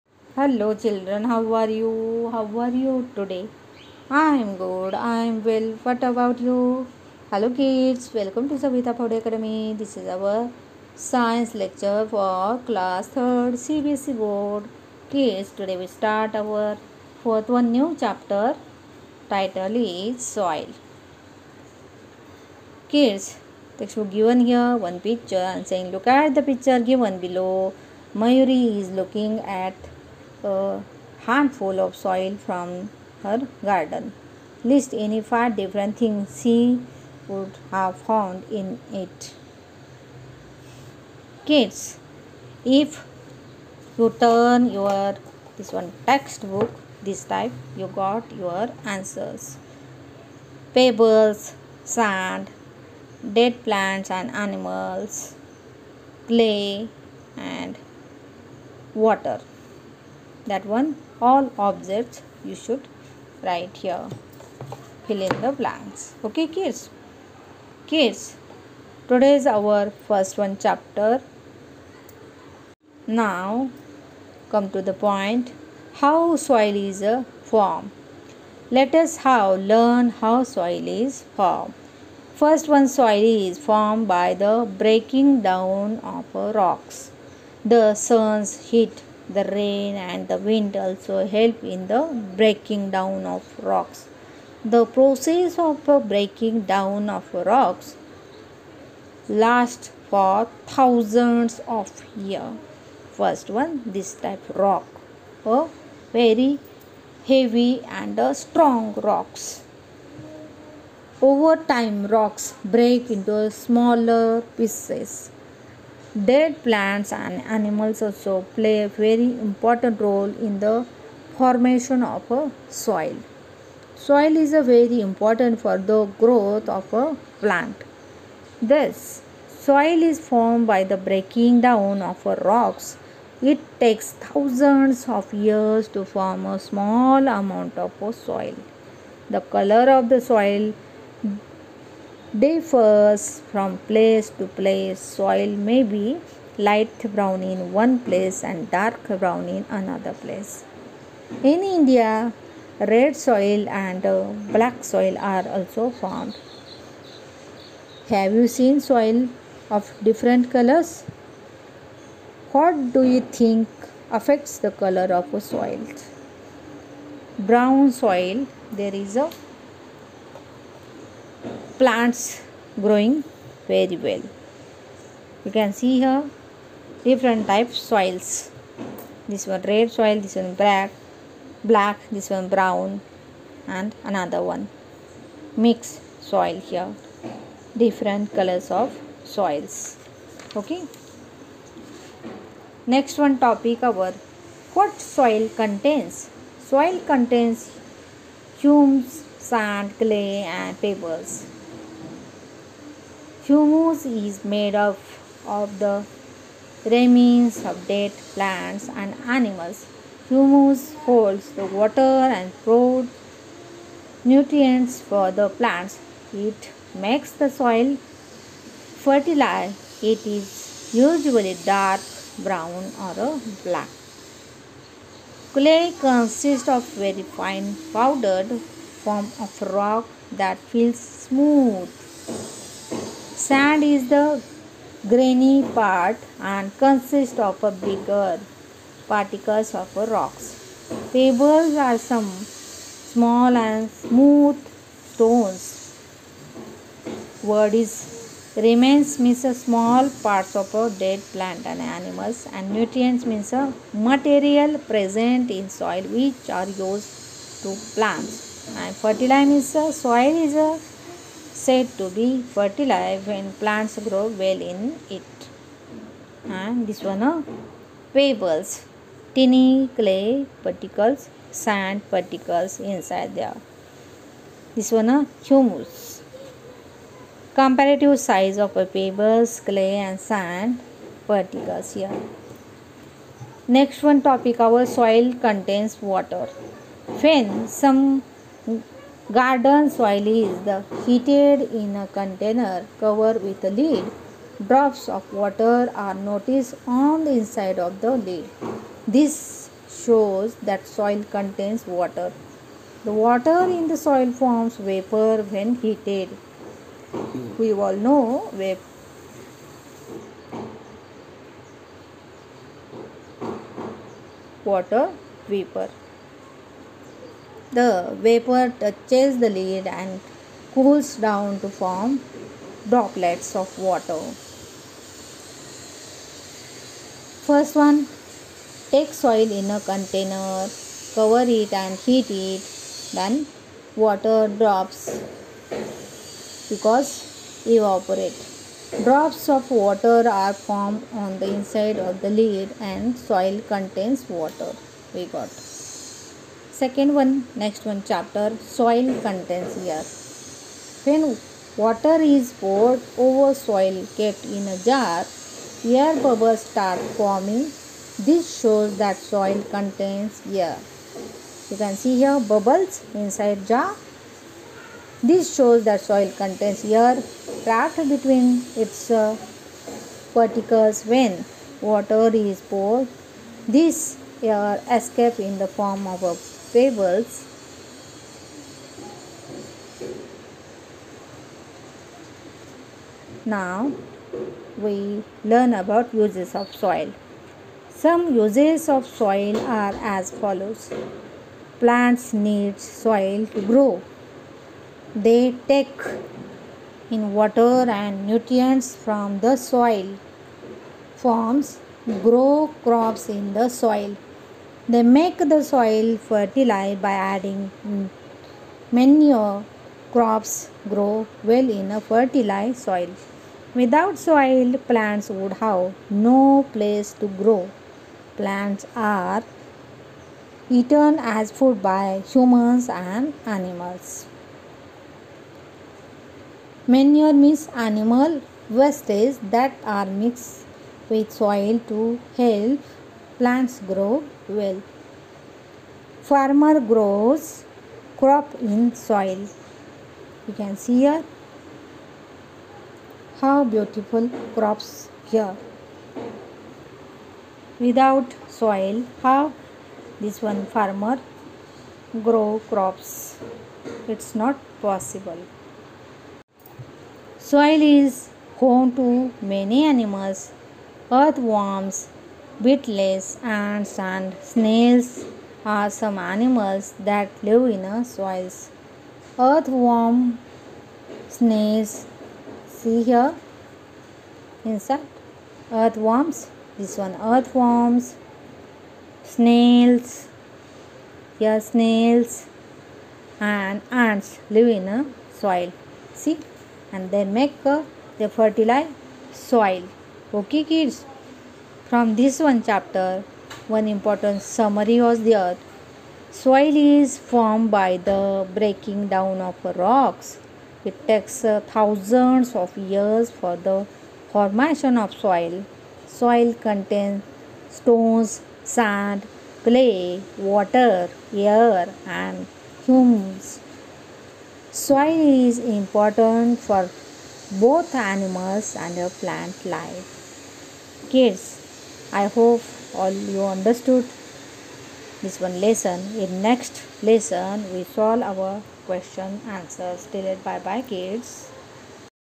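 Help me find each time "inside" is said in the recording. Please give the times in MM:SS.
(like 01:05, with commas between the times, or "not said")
04:32, 04:57, 05:41, 06:03, 07:54.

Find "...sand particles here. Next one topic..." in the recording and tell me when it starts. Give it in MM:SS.
04:40.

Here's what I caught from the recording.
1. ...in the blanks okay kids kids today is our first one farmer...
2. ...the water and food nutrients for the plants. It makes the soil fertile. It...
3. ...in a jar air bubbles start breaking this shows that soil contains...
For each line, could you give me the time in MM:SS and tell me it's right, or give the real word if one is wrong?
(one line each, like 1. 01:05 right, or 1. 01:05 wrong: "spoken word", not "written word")
1. 01:05 wrong: "chapter", not "farmer"
2. 03:31 right
3. 05:54 wrong: "forming", not "breaking".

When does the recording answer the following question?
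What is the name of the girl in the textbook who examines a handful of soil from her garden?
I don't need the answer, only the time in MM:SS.
00:28.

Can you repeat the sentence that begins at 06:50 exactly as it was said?
Crops grow well in a fertile soil.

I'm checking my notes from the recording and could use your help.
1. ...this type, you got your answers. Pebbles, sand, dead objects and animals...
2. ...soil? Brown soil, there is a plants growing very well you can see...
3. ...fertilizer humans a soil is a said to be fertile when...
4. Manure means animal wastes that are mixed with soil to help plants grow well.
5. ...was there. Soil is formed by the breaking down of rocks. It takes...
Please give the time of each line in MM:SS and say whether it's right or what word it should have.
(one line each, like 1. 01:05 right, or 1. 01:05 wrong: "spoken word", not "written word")
1. 00:47 wrong: "plants", not "objects"
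2. 02:45 right
3. 04:19 wrong: "means", not "humans"
4. 07:06 right
5. 08:15 right.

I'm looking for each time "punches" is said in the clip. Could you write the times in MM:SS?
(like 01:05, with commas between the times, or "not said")
not said.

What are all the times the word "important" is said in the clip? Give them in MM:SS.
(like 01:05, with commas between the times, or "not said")
01:59, 02:04, 08:13, 08:35.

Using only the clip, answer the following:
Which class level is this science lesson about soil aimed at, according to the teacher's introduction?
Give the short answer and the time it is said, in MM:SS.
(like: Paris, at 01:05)
Class 3, at 00:12.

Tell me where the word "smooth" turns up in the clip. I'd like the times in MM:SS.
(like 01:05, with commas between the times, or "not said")
03:51, 04:03.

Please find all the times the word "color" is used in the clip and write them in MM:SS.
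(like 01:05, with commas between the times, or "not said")
02:19, 02:40, 02:44, 03:08.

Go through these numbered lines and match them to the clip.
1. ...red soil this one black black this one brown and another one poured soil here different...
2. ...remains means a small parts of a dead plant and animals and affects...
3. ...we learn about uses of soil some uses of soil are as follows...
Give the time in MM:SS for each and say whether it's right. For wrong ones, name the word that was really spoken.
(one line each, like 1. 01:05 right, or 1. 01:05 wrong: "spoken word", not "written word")
1. 02:59 wrong: "mixed", not "poured"
2. 04:08 wrong: "nutrients", not "affects"
3. 06:24 right.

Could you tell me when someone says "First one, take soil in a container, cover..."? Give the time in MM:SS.
05:27.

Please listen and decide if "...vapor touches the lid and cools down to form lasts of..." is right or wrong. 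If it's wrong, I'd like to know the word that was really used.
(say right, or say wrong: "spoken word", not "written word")
wrong: "droplets", not "lasts".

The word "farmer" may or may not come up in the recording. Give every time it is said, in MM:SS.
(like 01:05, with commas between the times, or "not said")
07:16, 07:30.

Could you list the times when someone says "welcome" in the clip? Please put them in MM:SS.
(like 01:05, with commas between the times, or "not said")
00:08.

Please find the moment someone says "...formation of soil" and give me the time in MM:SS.
08:24.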